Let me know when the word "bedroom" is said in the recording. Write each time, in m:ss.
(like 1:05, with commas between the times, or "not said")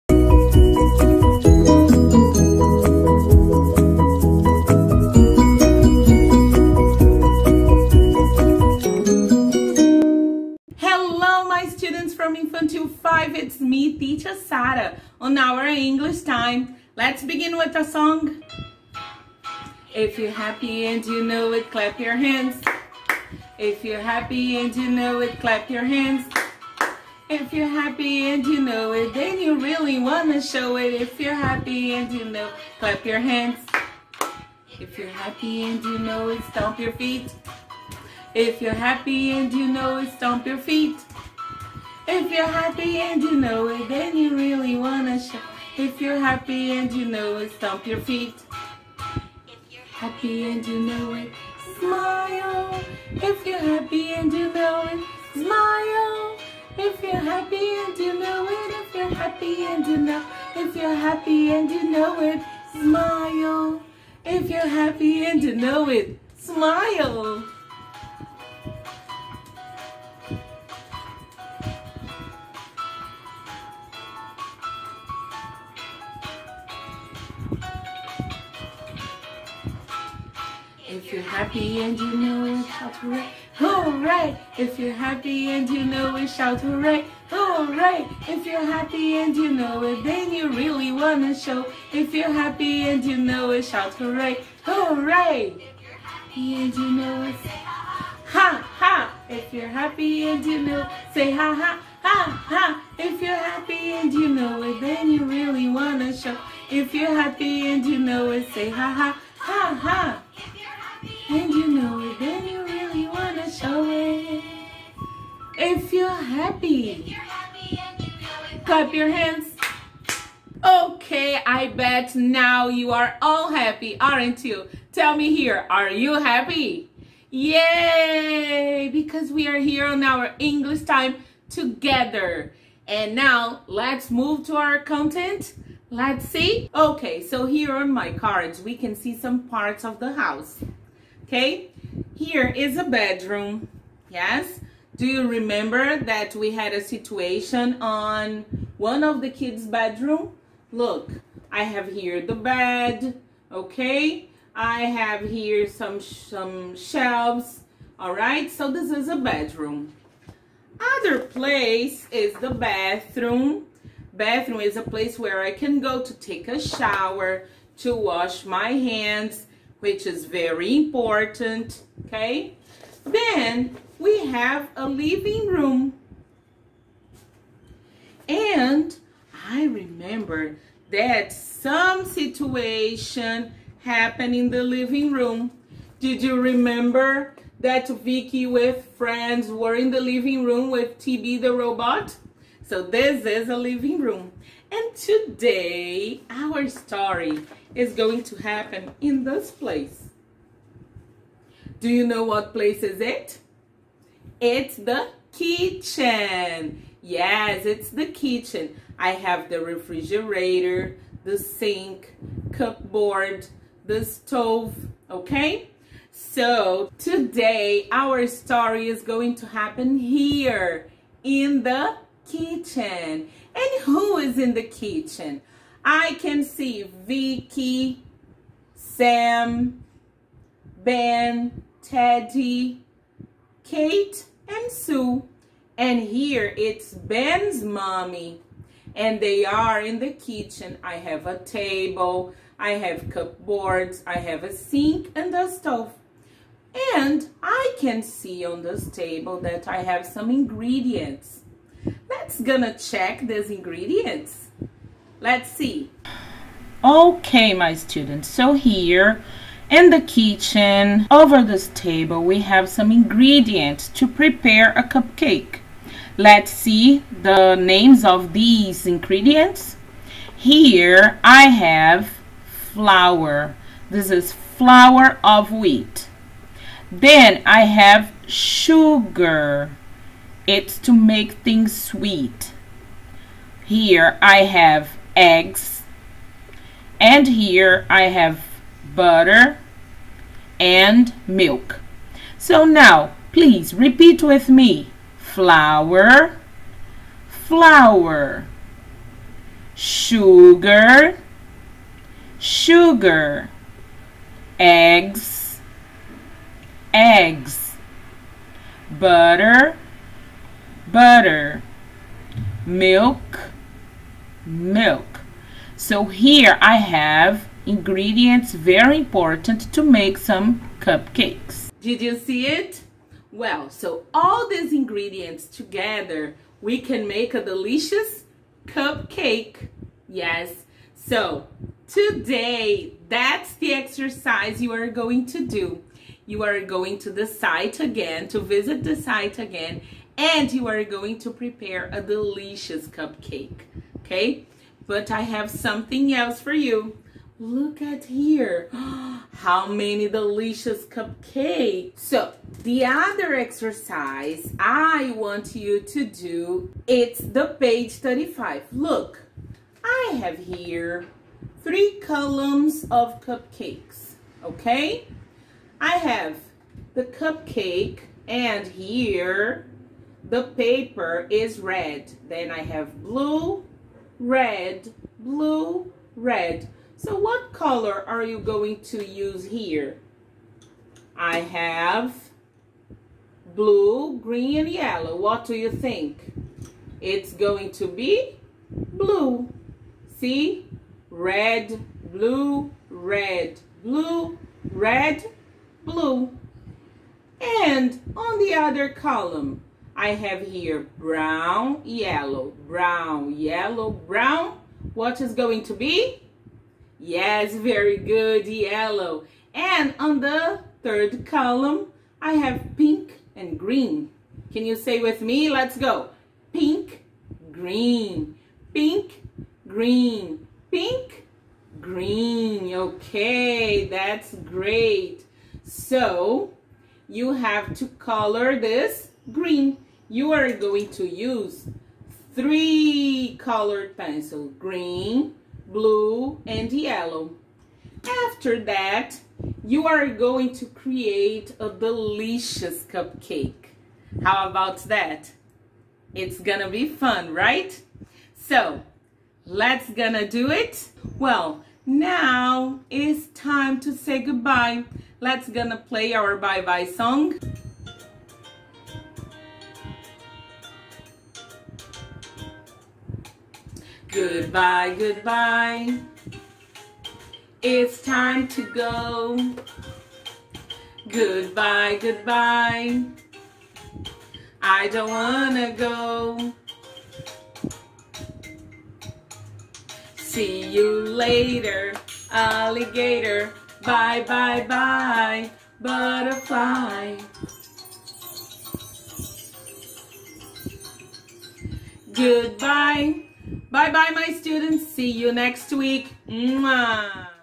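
2:22, 2:29, 2:39.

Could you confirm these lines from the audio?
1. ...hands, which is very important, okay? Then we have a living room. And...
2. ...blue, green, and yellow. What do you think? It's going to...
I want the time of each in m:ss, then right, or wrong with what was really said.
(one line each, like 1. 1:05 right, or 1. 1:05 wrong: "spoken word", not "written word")
1. 2:48 right
2. 6:23 right.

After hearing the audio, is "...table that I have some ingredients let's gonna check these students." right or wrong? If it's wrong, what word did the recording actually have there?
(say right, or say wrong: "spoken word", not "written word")
wrong: "ingredients", not "students".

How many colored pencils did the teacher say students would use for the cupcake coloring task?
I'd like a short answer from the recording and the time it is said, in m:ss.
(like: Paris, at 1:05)
3, at 7:12.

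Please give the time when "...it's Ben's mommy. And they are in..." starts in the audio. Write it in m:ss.
3:56.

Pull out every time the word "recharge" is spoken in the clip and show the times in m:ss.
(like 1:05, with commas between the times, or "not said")
not said.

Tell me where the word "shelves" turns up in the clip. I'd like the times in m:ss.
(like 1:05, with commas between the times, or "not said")
2:36.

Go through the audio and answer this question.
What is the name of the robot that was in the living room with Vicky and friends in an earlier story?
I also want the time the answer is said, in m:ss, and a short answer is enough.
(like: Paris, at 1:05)
TB, at 3:10.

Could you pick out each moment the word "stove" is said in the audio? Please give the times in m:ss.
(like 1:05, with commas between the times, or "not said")
3:34, 4:05.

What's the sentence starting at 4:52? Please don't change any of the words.
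So now, please repeat with me.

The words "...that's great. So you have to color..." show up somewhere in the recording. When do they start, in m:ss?
7:03.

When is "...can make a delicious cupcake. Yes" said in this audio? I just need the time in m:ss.
5:26.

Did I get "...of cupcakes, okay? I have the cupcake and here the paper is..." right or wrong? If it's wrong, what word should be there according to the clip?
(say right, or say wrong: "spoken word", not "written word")
right.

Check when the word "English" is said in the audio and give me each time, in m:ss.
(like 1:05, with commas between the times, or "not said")
0:15, 2:10.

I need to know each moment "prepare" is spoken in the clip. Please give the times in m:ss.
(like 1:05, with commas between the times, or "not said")
4:24, 5:41.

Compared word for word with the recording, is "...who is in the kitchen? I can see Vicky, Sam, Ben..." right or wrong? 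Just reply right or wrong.
right.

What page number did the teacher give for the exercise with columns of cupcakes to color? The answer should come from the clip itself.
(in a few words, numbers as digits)
35.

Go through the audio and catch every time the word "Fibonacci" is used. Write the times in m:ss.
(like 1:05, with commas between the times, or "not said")
not said.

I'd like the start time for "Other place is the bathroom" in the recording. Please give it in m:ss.
2:40.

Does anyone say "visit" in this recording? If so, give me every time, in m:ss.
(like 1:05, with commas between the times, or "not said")
5:38.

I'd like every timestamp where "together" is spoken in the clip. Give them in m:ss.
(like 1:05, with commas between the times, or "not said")
2:11, 5:25.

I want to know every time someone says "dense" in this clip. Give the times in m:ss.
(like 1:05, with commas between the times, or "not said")
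not said.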